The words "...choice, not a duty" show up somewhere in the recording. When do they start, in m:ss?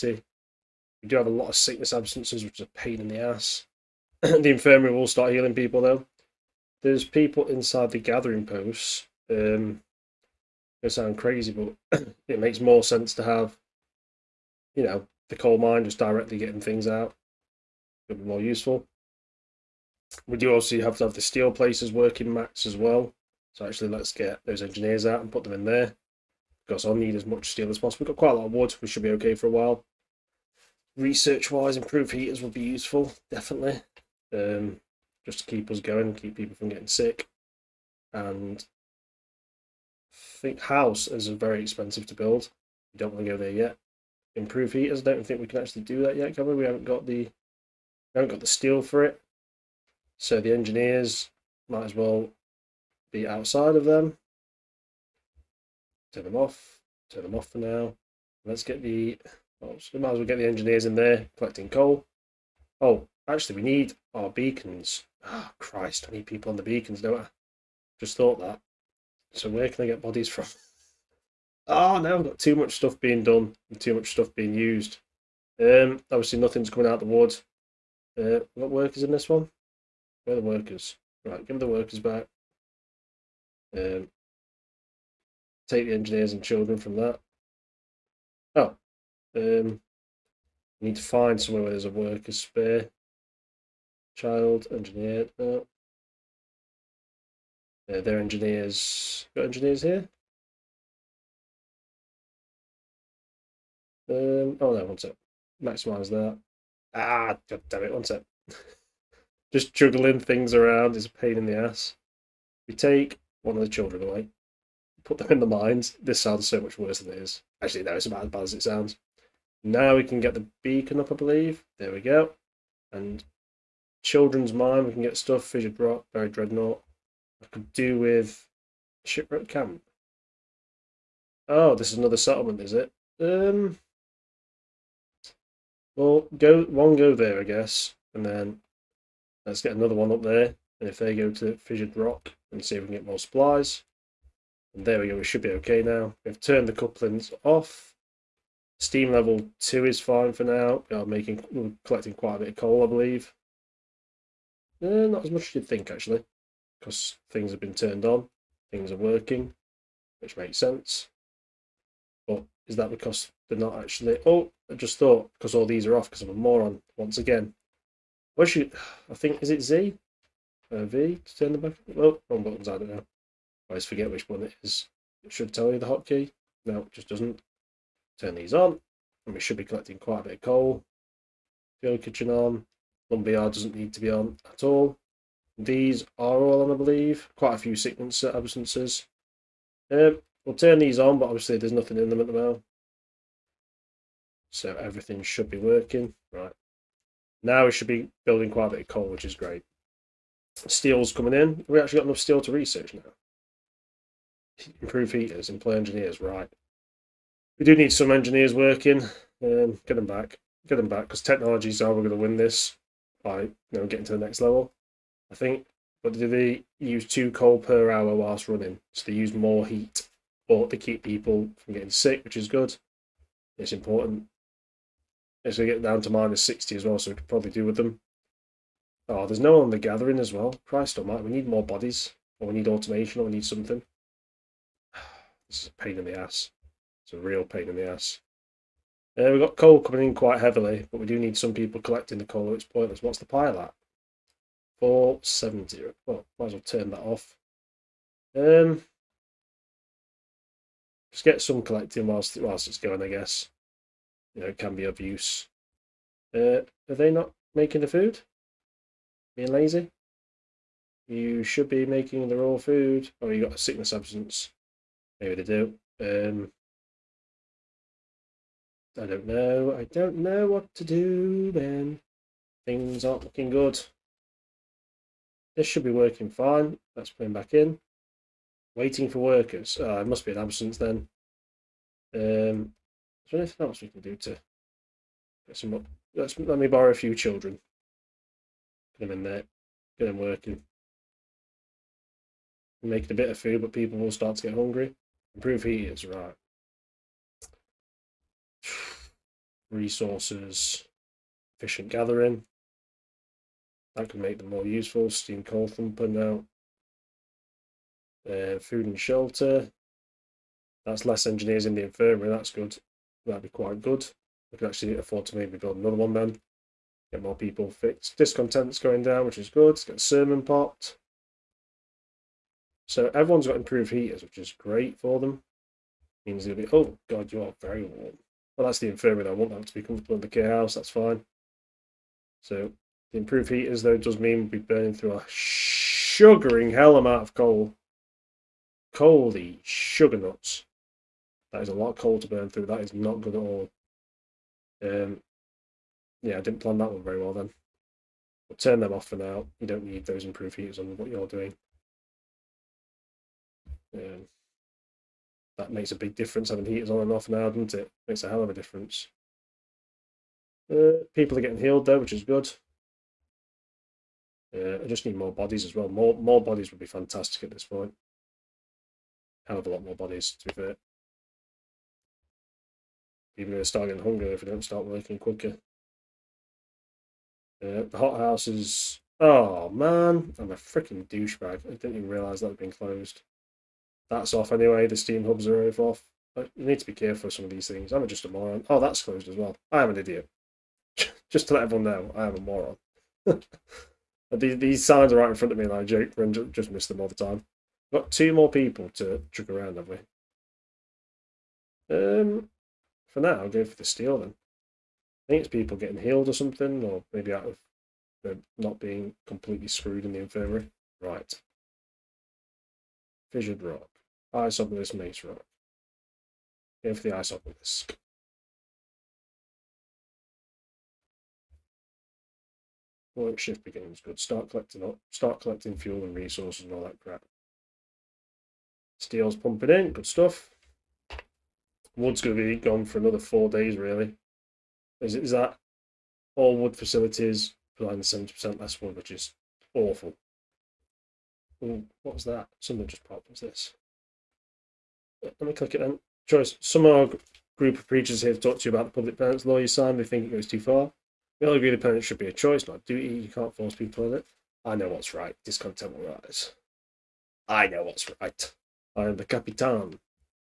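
7:32.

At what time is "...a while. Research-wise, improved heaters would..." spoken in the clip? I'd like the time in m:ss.
0:29.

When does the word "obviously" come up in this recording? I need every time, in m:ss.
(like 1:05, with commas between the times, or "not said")
1:16, 3:11.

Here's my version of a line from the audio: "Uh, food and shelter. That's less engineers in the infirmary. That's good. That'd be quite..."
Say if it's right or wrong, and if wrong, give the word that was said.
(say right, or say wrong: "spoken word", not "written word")
right.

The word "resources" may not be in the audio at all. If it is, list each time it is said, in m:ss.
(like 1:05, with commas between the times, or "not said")
4:59, 7:06.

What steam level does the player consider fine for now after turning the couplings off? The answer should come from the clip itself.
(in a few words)
2.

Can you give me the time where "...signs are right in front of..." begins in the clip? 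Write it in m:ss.
6:34.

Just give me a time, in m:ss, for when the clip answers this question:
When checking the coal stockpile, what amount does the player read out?
4:04.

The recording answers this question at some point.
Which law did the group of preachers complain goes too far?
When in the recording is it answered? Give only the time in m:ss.
7:28.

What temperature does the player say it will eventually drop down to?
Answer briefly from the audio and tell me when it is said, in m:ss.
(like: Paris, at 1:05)
-60, at 3:46.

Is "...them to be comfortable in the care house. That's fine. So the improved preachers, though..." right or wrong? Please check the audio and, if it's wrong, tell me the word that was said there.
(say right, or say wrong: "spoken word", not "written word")
wrong: "heaters", not "preachers".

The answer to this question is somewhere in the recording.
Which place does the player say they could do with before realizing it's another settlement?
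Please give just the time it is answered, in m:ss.
2:09.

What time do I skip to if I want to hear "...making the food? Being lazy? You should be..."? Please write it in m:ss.
4:17.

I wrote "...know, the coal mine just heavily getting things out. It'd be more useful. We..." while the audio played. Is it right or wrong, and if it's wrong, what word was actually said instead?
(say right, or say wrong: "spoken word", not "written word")
wrong: "directly", not "heavily".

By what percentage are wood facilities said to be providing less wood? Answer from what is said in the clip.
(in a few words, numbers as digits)
70%.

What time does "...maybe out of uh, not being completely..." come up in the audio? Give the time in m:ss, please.
6:47.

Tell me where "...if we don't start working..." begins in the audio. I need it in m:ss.
6:14.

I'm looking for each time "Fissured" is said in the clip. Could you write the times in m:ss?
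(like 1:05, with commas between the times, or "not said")
2:05, 2:21, 6:53.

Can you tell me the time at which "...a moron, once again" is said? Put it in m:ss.
2:46.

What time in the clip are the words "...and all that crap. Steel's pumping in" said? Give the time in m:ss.
7:06.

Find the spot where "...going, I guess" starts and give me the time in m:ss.
4:12.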